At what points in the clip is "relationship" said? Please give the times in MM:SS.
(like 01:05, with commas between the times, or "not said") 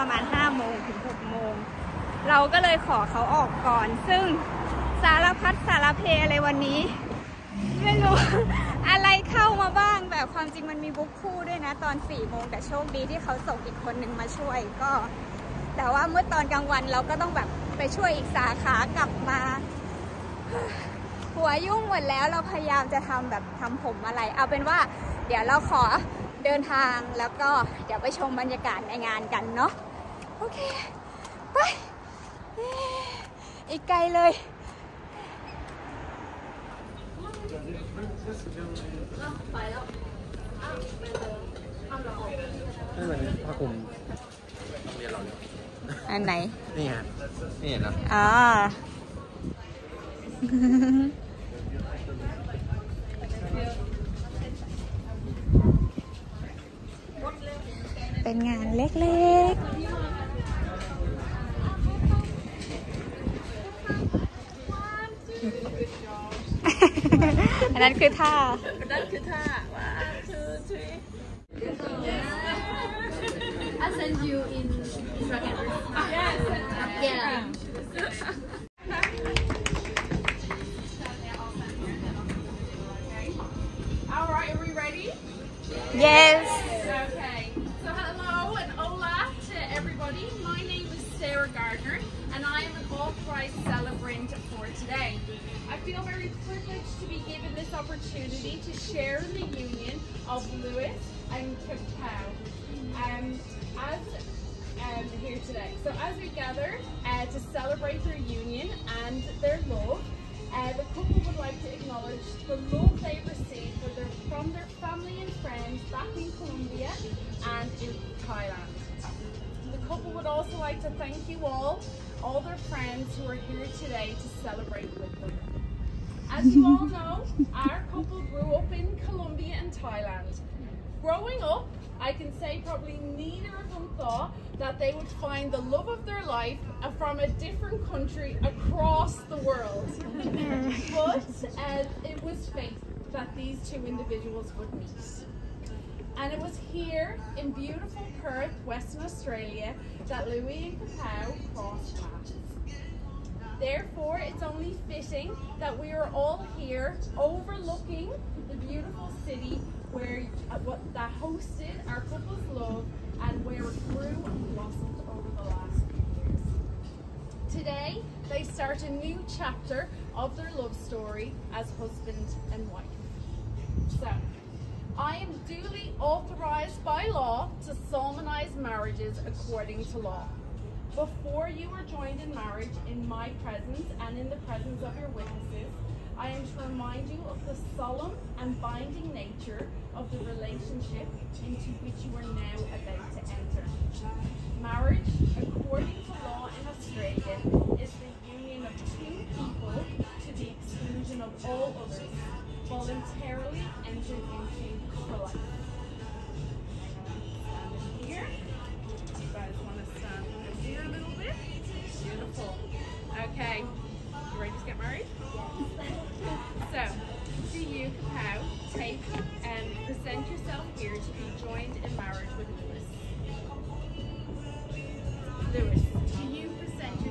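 03:10.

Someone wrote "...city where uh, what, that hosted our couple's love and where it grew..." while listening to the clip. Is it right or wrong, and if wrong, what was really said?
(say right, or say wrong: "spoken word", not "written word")
right.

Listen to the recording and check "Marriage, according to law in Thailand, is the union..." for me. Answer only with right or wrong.
wrong.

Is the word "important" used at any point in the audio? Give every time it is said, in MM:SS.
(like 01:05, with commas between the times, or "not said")
not said.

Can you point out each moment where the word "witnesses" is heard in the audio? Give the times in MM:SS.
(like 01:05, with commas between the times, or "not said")
03:05.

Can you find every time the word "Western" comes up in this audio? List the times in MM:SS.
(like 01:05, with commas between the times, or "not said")
02:28.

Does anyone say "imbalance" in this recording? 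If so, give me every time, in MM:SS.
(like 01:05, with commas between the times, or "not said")
not said.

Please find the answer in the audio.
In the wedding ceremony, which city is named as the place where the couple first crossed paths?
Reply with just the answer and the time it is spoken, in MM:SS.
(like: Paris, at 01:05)
Perth, at 02:28.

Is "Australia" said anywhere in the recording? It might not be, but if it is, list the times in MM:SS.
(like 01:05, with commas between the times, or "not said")
02:29, 03:16.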